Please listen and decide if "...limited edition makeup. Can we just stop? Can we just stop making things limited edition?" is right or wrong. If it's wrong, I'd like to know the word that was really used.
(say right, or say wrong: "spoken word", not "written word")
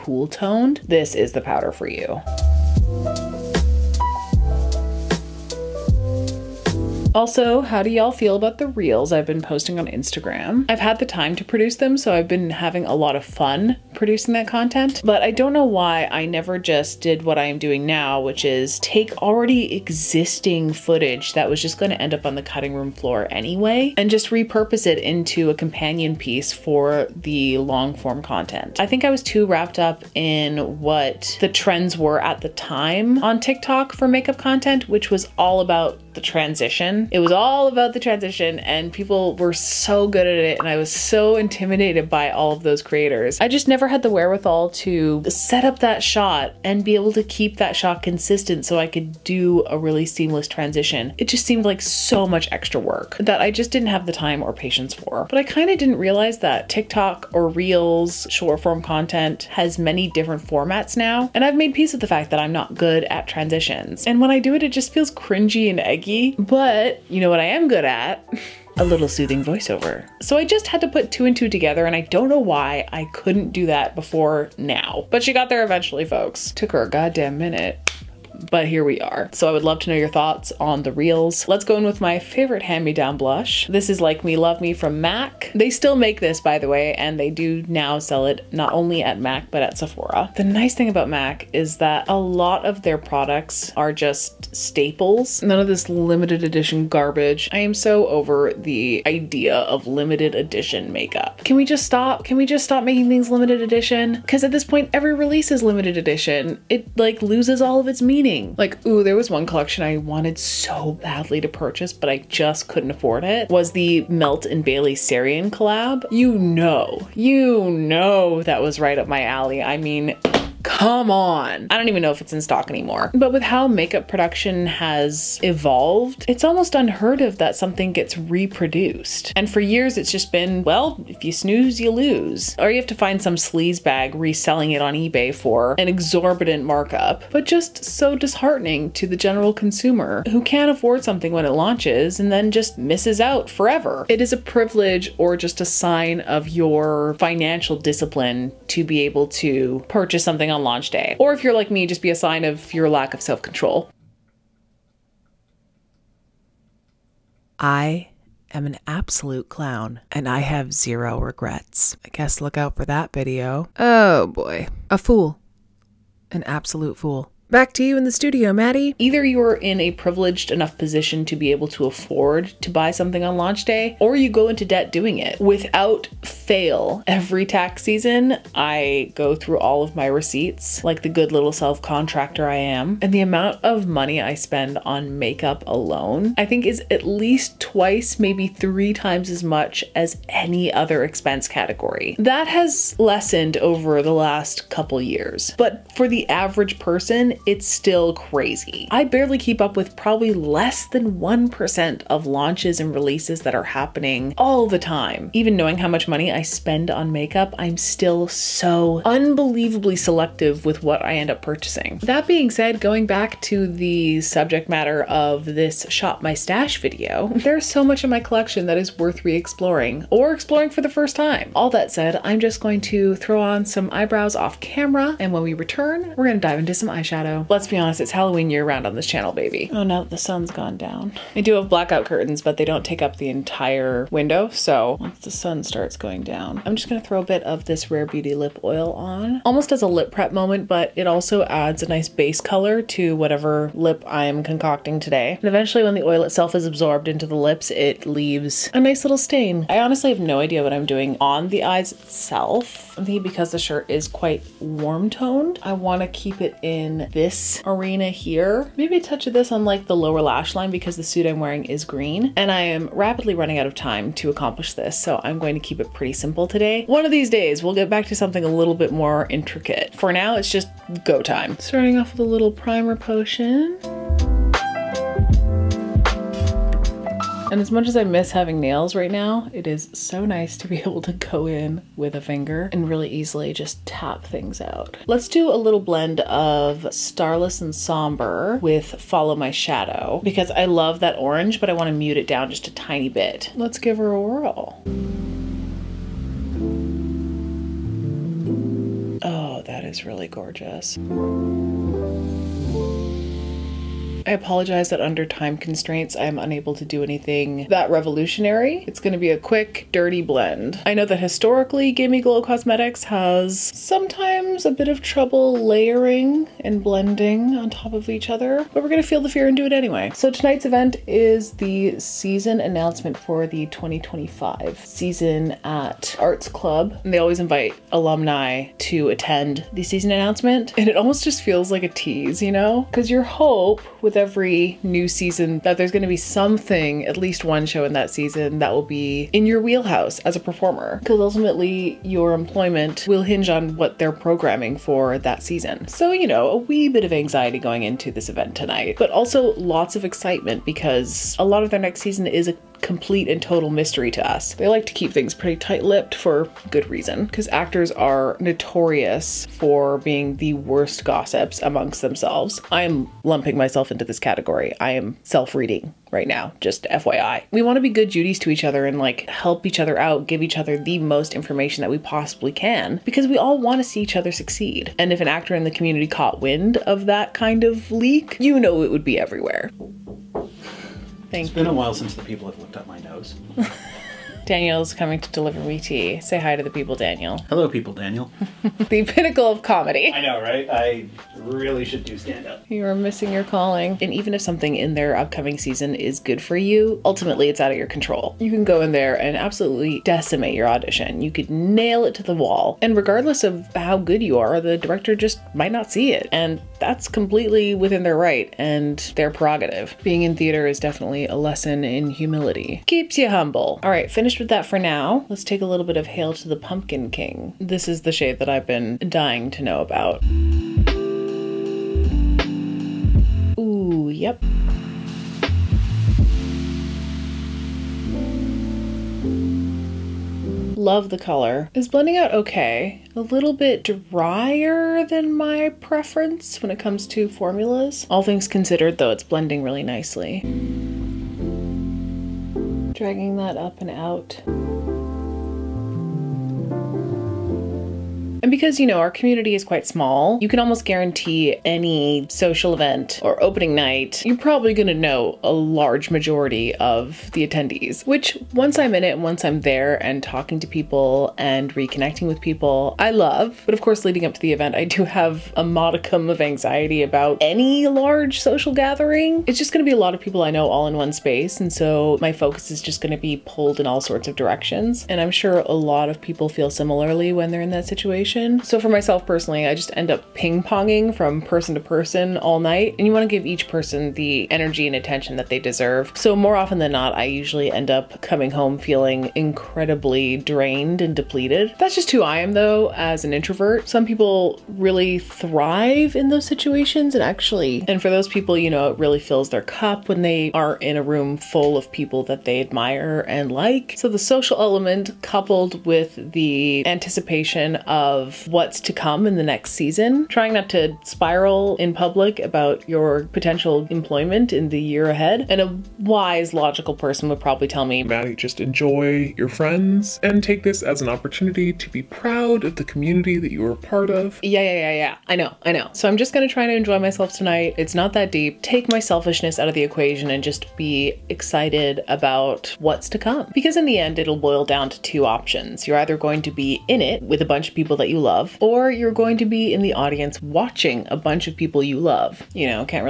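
right.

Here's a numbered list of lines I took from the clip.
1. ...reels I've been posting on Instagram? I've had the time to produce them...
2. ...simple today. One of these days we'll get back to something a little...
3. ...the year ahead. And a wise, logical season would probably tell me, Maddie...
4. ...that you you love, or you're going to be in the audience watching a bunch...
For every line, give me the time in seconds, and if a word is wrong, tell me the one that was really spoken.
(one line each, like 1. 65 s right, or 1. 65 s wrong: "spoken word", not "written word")
1. 8 s right
2. 266 s right
3. 514 s wrong: "person", not "season"
4. 537 s right.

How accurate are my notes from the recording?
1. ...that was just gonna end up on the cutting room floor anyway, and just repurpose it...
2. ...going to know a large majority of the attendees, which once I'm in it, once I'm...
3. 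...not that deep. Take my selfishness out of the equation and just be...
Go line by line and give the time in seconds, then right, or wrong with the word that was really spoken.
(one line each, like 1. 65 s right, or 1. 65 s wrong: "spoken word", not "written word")
1. 21 s right
2. 454 s right
3. 527 s right.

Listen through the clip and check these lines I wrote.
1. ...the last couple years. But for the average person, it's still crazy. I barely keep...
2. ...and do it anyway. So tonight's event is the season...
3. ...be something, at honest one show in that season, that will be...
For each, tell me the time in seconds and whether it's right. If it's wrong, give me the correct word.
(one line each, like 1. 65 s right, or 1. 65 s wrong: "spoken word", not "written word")
1. 194 s right
2. 319 s right
3. 336 s wrong: "least", not "honest".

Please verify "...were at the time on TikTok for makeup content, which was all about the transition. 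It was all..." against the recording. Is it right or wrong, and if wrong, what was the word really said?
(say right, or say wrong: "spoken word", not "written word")
right.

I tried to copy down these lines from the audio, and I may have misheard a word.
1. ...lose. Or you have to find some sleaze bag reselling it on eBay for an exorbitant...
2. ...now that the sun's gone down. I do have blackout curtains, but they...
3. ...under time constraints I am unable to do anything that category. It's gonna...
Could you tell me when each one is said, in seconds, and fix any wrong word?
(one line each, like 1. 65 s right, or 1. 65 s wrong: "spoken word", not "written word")
1. 131 s right
2. 229 s right
3. 305 s wrong: "revolutionary", not "category".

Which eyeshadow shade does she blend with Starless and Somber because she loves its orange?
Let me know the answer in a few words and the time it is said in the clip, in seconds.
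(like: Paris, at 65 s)
Follow My Shadow, at 288 s.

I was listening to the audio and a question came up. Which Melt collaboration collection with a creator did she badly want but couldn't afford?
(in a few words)
Melt and Bailey Sarian.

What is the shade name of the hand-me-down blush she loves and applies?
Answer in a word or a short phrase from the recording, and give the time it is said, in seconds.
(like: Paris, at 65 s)
Like Me Love Me, at 83 s.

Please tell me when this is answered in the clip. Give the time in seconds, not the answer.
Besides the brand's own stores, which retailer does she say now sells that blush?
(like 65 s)
89 s.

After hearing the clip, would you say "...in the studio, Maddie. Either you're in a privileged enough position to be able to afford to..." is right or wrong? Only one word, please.
right.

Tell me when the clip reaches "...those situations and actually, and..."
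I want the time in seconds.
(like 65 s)
496 s.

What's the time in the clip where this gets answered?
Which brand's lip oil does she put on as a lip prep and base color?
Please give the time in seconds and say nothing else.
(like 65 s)
237 s.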